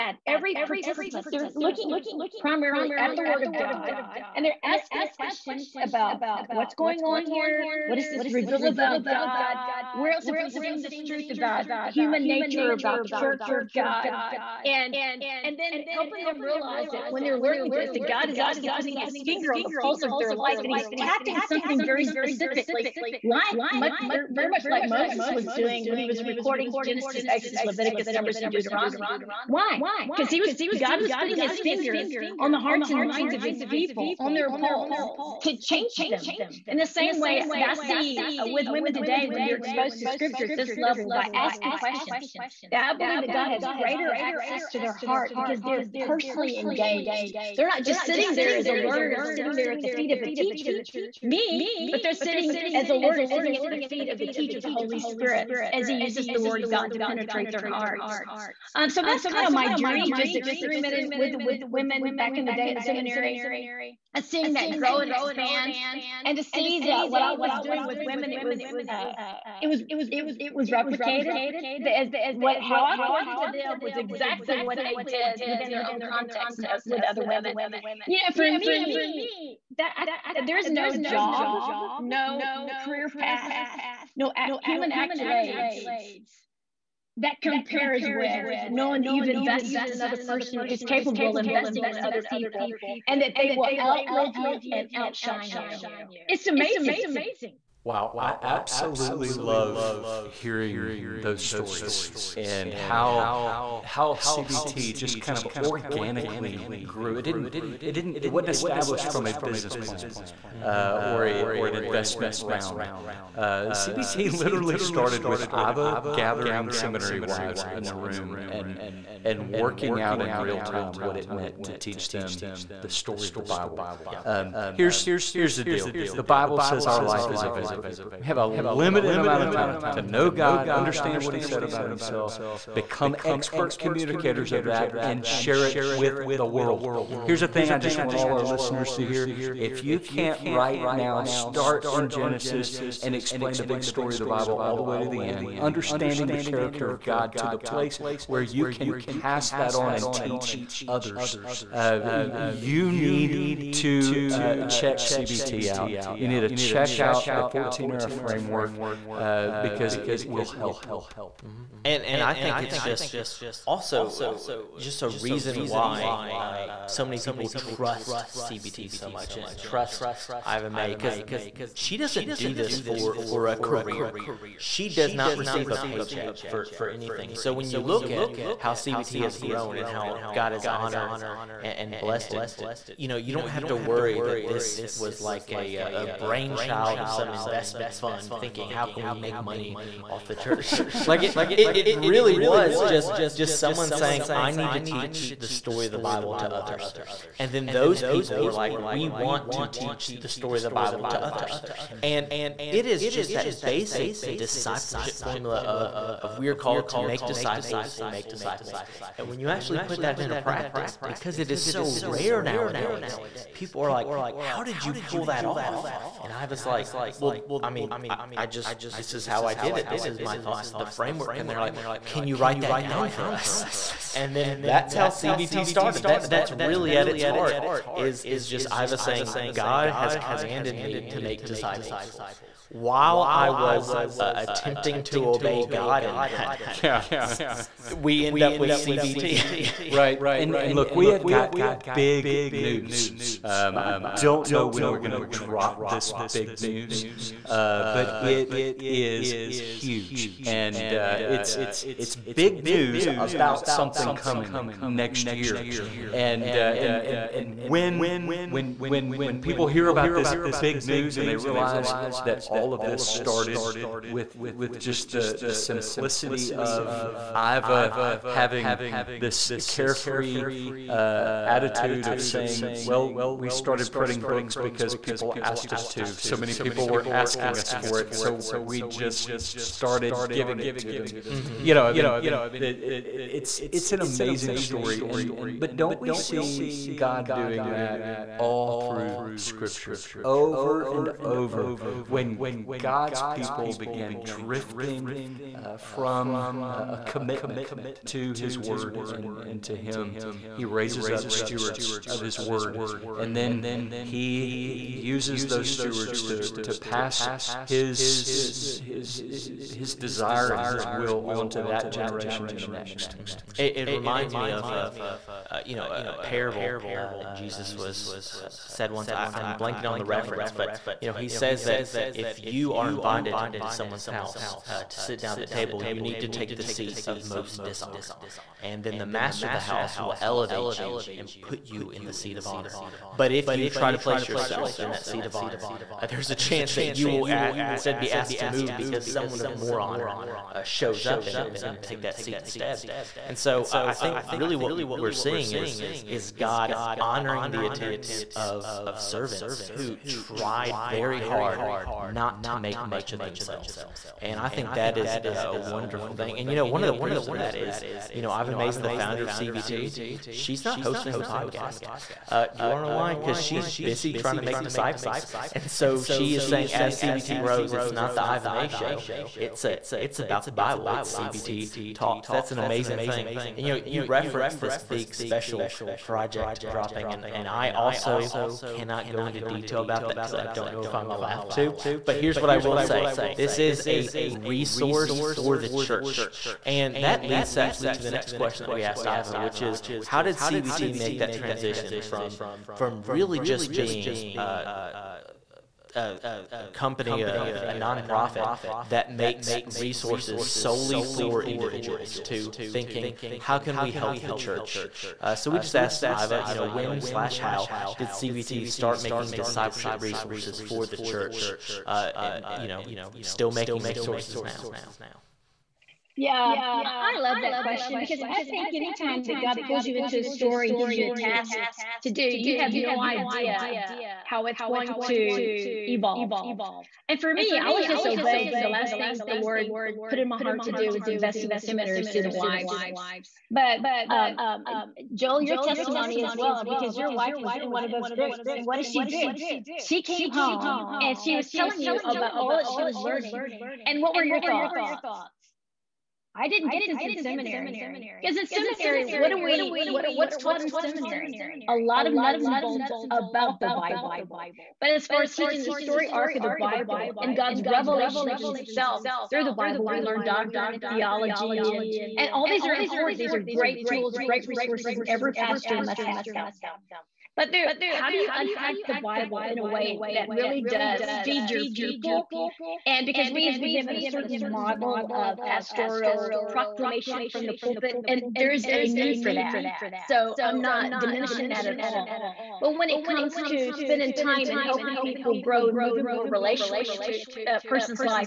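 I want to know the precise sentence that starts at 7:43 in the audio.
These are great tools, great resources, and every pastor must have them.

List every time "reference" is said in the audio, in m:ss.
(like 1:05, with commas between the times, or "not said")
5:20, 6:14.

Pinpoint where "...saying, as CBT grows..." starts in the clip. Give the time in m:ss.
6:06.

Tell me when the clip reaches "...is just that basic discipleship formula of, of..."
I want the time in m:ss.
3:22.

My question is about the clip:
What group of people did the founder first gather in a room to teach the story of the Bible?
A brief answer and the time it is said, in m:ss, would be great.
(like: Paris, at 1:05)
Seminary wives, at 1:56.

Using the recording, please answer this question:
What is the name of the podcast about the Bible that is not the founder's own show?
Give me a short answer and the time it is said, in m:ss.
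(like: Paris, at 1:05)
CBT talks, at 6:11.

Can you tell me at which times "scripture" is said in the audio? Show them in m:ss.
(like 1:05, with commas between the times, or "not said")
0:40, 4:49.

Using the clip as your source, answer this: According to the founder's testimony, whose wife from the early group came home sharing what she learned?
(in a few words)
Joel.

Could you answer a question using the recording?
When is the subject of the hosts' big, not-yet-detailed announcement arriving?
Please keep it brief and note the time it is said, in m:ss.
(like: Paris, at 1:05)
Next year, at 4:14.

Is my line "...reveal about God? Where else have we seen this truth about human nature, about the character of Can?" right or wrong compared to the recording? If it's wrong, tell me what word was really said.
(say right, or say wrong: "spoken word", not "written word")
wrong: "God", not "Can".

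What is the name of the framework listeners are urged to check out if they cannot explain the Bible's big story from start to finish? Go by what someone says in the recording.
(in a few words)
14 era framework.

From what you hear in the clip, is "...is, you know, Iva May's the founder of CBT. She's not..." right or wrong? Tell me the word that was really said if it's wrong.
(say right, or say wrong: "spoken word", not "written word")
right.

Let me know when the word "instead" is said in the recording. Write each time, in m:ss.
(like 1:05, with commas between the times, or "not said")
5:37, 5:42.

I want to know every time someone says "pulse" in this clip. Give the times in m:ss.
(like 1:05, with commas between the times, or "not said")
0:19, 0:34.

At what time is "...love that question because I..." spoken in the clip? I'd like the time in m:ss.
6:57.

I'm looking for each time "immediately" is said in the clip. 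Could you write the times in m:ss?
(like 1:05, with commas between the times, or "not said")
not said.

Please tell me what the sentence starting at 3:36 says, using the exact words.
And I was like, Well, I mean, I, I just, this is how I did it.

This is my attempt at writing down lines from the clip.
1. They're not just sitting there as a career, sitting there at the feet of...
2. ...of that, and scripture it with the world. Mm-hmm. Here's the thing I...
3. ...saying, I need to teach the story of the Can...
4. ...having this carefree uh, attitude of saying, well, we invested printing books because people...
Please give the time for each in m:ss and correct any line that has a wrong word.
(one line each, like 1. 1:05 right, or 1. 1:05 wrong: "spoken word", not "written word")
1. 0:47 wrong: "learner", not "career"
2. 2:14 wrong: "share", not "scripture"
3. 3:13 wrong: "Bible", not "Can"
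4. 4:28 wrong: "started", not "invested".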